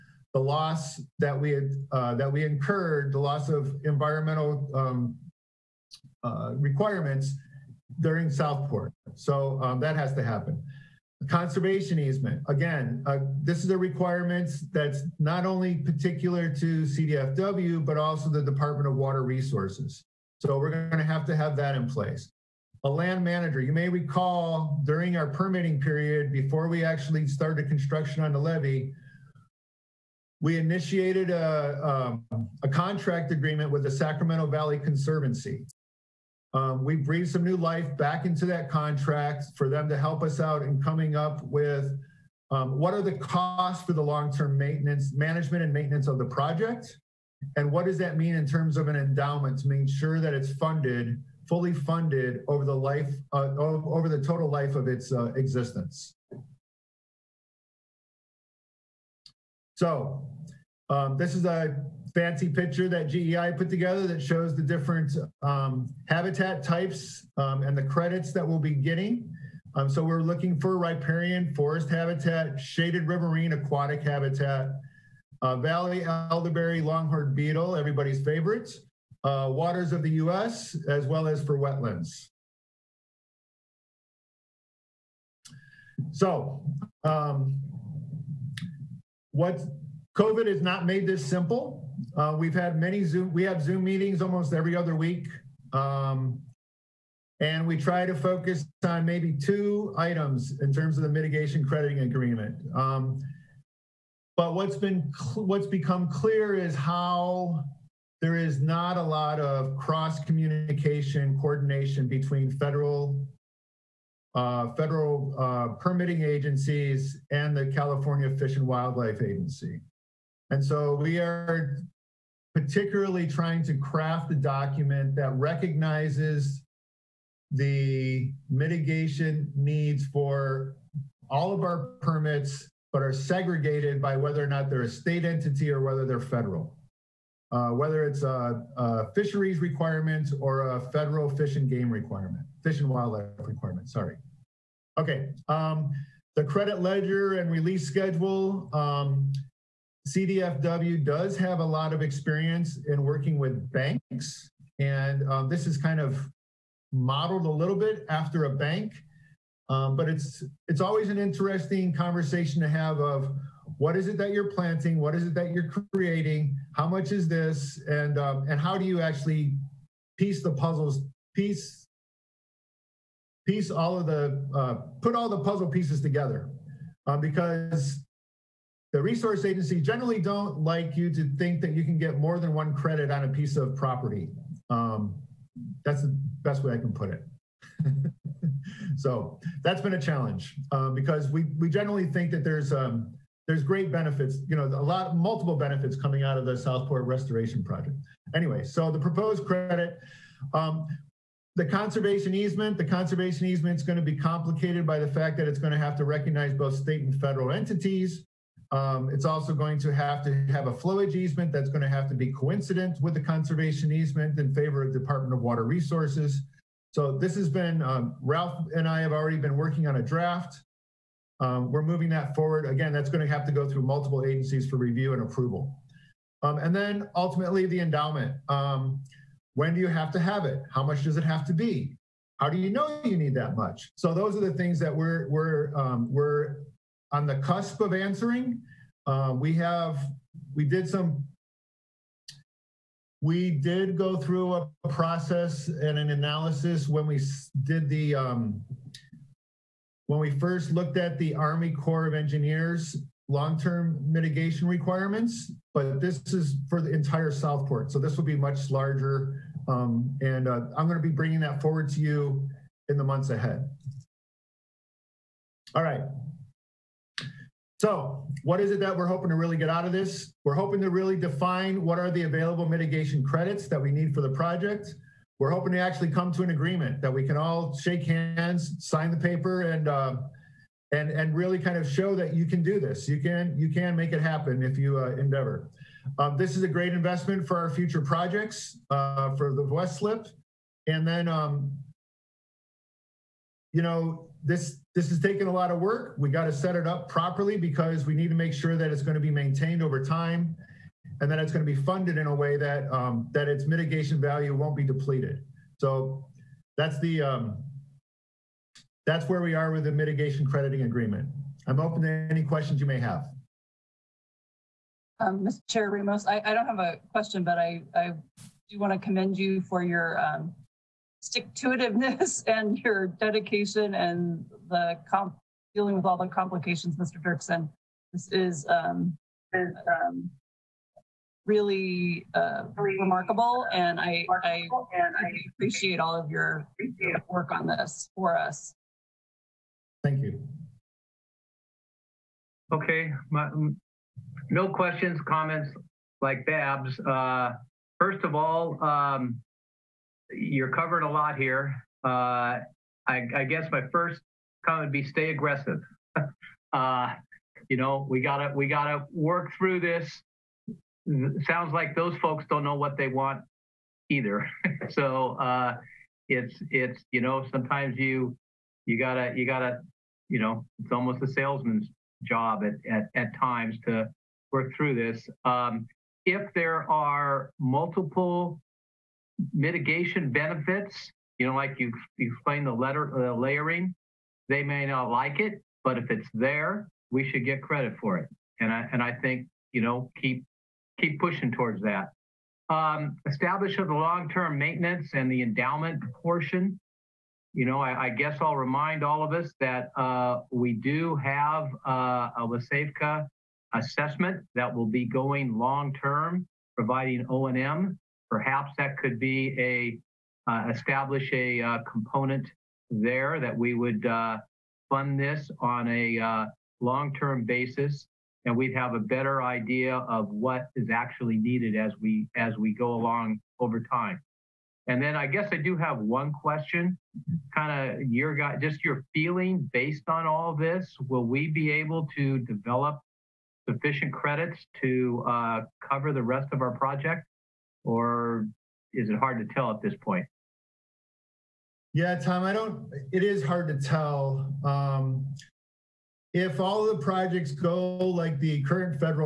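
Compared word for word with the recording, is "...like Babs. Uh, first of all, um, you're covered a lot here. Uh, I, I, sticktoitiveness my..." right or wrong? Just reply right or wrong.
wrong.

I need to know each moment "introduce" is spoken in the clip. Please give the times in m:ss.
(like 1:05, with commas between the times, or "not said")
not said.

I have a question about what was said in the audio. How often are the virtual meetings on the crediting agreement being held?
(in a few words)
almost every other week.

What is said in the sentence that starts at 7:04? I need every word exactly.
And then I guess I do have one question, kind of your guy, just your feeling based on all this.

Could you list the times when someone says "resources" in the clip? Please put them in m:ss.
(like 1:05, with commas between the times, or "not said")
0:19, 2:59, 3:35.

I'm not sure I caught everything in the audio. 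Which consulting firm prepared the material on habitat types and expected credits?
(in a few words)
GEI.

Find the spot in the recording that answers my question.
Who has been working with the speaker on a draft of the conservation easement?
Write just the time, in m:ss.
3:38.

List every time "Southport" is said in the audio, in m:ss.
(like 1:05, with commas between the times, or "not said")
0:08, 3:16, 4:17.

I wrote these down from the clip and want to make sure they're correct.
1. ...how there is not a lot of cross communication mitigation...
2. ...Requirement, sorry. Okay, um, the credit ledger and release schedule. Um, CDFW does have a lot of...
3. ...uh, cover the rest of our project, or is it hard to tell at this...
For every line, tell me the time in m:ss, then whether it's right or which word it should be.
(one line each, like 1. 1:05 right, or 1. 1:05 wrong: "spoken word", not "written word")
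1. 1:46 wrong: "coordination", not "mitigation"
2. 2:23 right
3. 7:15 right.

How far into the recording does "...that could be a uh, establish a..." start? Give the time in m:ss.
6:48.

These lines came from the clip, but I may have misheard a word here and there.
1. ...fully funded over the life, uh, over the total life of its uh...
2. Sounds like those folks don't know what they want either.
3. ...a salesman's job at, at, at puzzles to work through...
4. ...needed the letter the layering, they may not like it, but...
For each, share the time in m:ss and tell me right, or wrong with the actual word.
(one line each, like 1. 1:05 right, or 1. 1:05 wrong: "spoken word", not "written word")
1. 0:51 right
2. 6:01 right
3. 6:11 wrong: "times", not "puzzles"
4. 6:22 wrong: "explained", not "needed".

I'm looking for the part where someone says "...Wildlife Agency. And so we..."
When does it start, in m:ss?
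1:58.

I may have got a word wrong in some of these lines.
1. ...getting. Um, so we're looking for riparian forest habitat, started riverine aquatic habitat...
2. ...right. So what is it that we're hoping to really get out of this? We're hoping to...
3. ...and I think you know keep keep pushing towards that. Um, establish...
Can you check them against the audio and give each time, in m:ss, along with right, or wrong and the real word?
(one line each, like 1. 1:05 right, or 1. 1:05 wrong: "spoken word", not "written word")
1. 1:08 wrong: "shaded", not "started"
2. 4:25 right
3. 6:28 right.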